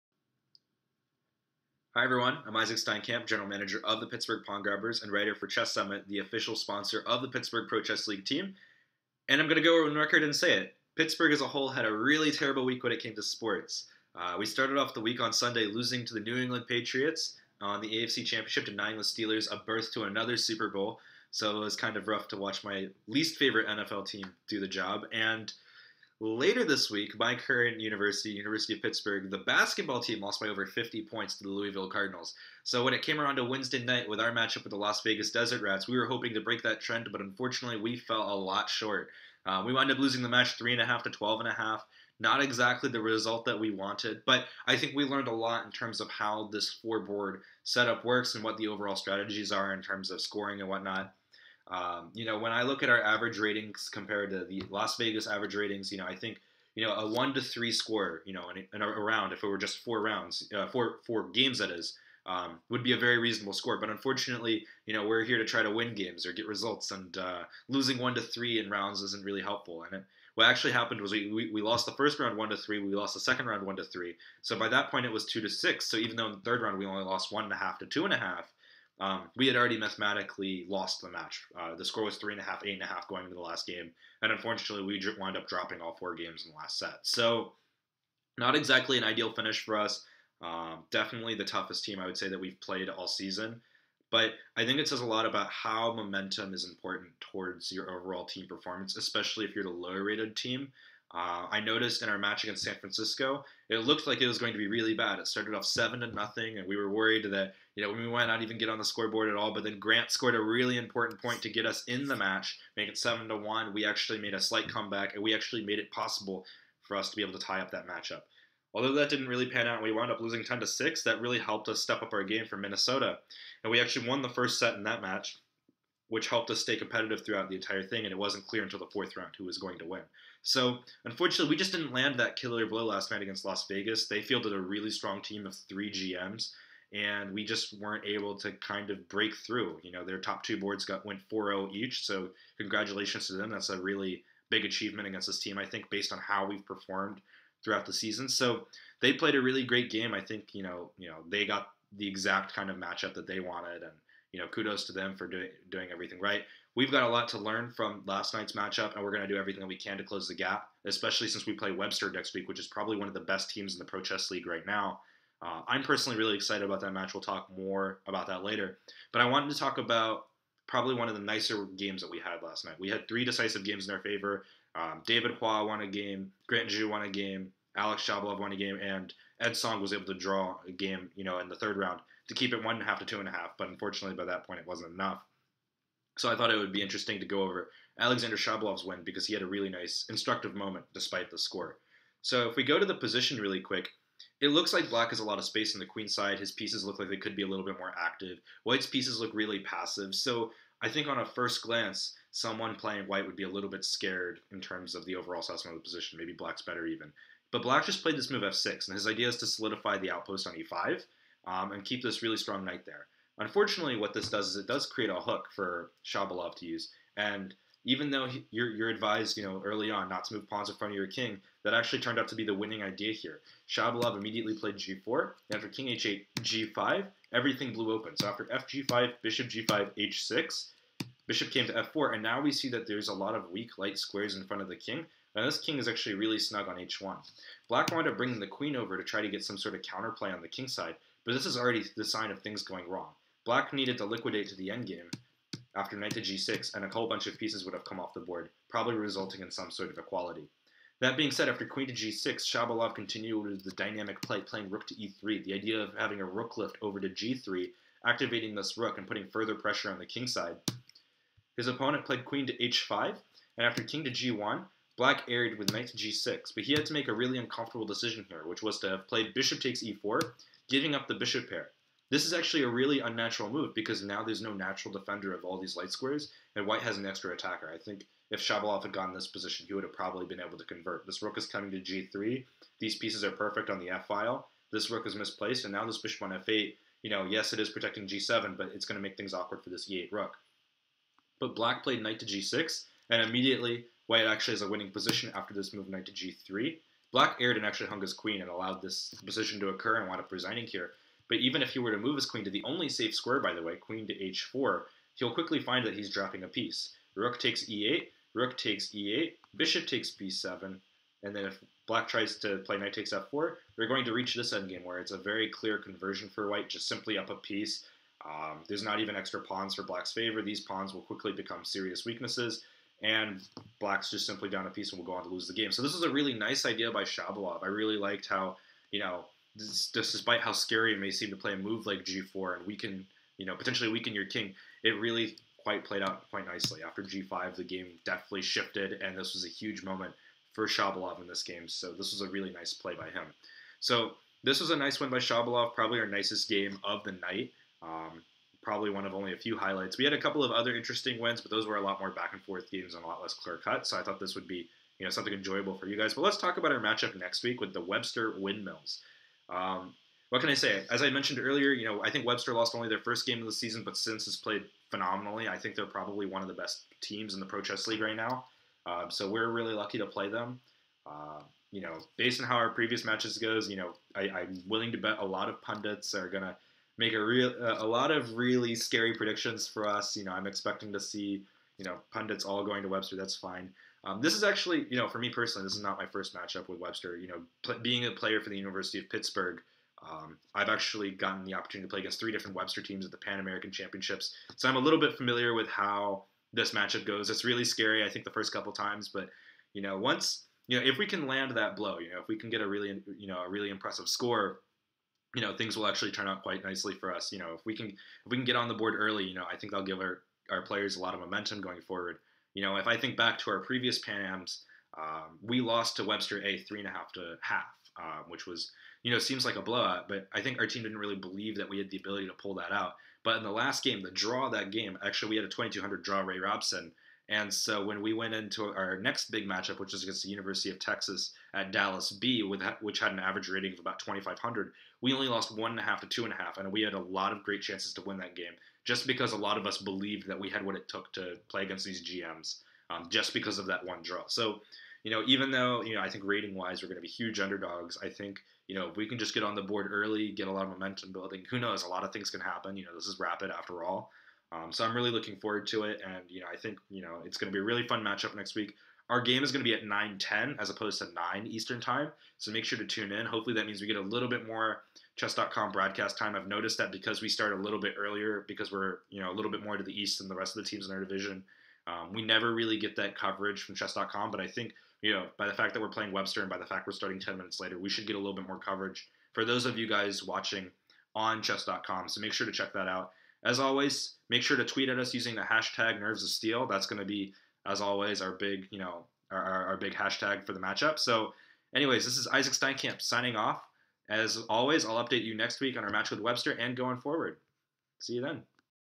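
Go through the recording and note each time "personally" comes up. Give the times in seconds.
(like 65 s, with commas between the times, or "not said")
165 s, 385 s.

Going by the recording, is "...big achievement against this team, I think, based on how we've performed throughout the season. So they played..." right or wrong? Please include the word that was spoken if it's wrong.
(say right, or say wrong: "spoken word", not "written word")
right.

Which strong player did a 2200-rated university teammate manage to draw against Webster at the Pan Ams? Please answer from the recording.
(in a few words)
Ray Robson.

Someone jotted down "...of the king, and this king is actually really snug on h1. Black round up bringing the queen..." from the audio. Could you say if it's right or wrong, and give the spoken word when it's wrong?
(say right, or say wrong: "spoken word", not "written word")
wrong: "wound", not "round".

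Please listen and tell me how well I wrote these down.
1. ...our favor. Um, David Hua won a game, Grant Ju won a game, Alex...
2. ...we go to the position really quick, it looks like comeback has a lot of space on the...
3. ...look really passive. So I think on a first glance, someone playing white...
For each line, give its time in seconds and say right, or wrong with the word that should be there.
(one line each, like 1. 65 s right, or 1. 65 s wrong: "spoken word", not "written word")
1. 173 s right
2. 192 s wrong: "black", not "comeback"
3. 199 s right.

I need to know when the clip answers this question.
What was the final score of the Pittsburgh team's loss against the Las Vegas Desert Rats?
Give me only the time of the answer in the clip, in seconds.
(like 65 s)
40 s.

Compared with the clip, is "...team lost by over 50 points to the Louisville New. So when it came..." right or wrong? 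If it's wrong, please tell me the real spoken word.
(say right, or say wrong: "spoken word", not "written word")
wrong: "Cardinals", not "New".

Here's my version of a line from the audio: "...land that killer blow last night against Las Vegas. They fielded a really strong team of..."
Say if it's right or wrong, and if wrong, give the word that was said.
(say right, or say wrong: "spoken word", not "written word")
right.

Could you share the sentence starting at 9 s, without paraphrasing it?
And I'm going to go on record and say it.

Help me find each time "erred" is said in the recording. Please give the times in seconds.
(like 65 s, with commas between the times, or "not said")
265 s, 297 s.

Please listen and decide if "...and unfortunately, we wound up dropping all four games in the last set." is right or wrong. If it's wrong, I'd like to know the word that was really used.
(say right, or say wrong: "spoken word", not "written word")
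right.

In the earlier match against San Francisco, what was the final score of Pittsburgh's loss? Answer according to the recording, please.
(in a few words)
10 to 6.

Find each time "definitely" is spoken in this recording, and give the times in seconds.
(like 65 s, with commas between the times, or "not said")
90 s, 338 s.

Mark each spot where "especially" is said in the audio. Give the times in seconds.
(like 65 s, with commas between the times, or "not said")
98 s, 160 s.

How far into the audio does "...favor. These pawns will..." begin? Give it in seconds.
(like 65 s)
320 s.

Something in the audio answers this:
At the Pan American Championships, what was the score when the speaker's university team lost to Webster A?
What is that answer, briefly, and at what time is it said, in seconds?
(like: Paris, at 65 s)
3.5 to 0.5, at 416 s.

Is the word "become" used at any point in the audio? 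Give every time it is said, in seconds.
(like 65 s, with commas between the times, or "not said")
321 s.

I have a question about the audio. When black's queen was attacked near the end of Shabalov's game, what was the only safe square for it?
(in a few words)
h4.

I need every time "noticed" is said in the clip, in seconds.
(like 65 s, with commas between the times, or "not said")
101 s, 466 s.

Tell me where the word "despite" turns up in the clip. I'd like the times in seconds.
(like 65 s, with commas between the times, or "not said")
190 s, 329 s.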